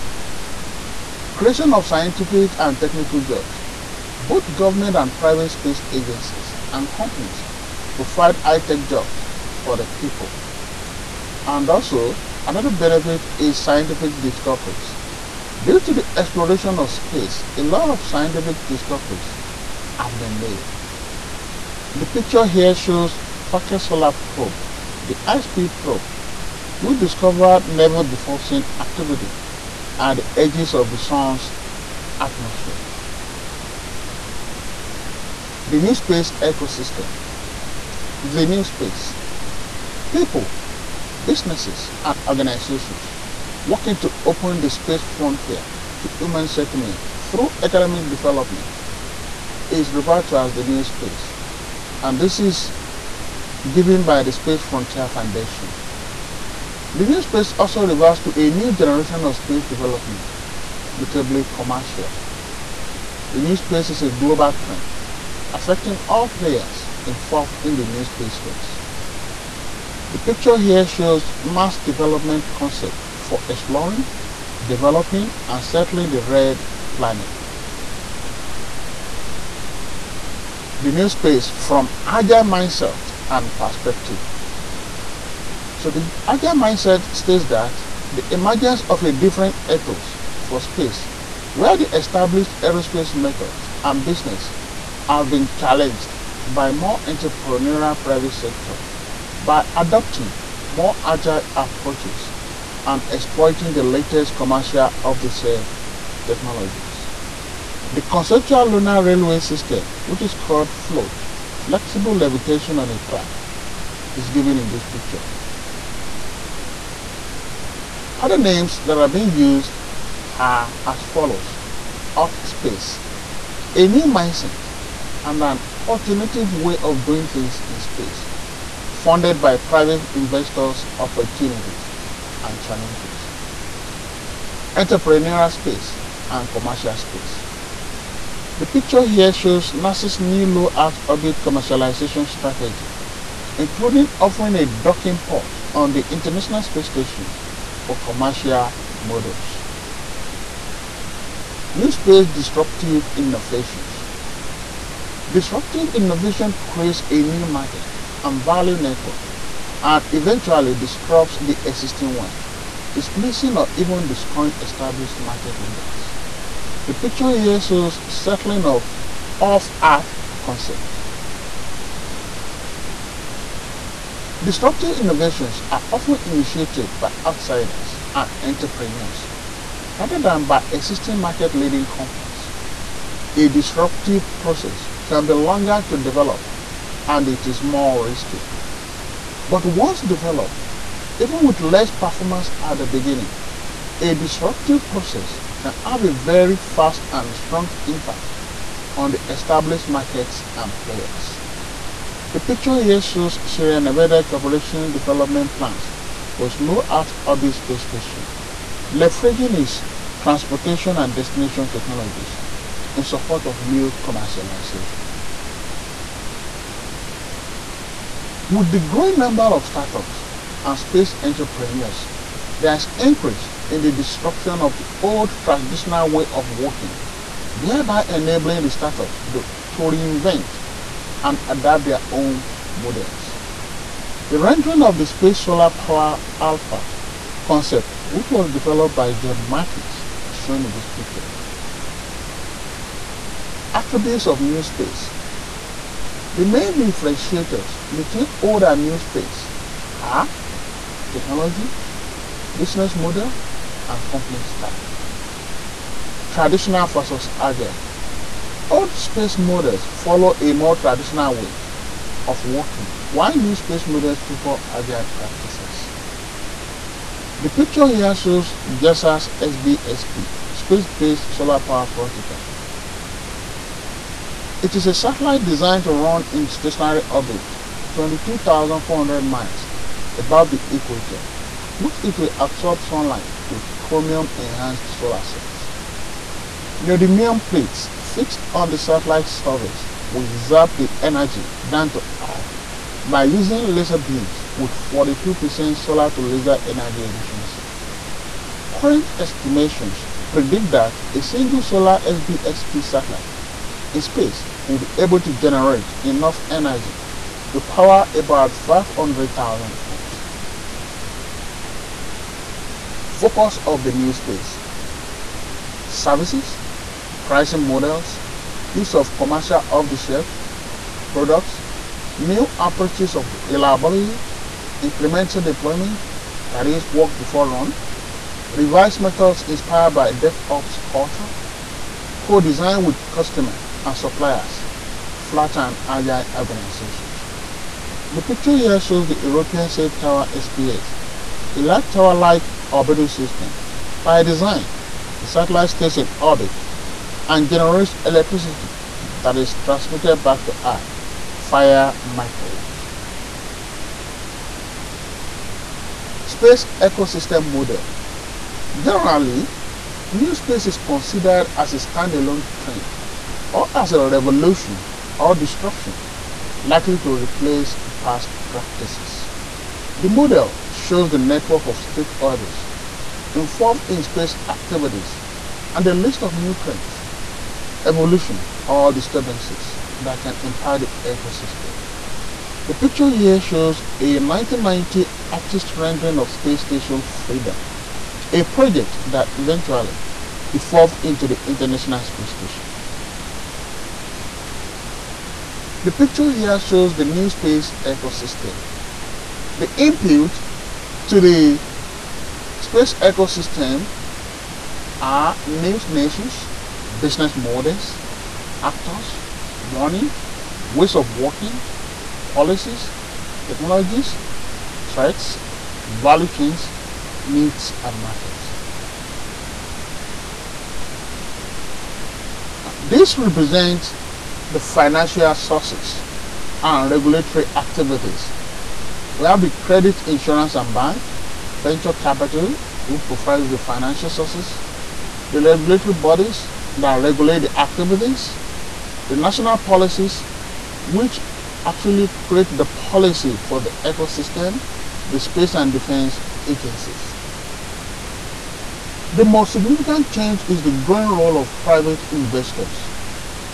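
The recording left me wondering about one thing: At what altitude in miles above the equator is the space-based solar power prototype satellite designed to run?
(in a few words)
22,400 miles.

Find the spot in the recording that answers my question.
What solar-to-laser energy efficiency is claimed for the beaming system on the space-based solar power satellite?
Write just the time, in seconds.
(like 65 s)
294 s.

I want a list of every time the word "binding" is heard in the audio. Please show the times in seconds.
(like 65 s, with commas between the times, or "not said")
not said.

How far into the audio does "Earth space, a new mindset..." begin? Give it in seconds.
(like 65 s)
122 s.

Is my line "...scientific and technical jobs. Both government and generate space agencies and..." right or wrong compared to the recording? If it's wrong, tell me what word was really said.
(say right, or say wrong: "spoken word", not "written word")
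wrong: "private", not "generate".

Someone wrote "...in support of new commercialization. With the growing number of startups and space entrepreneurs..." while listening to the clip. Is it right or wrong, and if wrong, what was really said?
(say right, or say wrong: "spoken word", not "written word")
right.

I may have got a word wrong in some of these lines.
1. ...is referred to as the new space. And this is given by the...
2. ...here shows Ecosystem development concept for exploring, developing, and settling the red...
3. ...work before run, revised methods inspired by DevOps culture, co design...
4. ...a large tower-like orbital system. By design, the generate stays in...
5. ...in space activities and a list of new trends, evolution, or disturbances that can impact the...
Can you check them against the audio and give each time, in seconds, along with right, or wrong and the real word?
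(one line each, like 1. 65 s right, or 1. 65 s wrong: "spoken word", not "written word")
1. 49 s right
2. 70 s wrong: "Mars", not "Ecosystem"
3. 326 s right
4. 341 s wrong: "satellite", not "generate"
5. 373 s right.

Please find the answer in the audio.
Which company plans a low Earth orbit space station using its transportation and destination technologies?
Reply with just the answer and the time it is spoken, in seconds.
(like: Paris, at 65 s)
Sierra Nevada Corporation, at 203 s.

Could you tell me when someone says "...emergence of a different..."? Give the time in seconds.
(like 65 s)
88 s.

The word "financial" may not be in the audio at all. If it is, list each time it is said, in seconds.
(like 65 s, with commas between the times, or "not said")
424 s, 433 s.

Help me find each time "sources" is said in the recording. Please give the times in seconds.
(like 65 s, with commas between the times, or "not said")
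425 s, 434 s.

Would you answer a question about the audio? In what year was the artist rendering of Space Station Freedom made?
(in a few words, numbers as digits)
1990.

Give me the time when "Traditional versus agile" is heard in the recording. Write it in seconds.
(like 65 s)
256 s.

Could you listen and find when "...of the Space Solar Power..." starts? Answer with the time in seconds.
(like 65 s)
234 s.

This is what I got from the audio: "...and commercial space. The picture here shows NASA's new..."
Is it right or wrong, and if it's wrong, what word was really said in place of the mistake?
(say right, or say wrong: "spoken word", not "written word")
right.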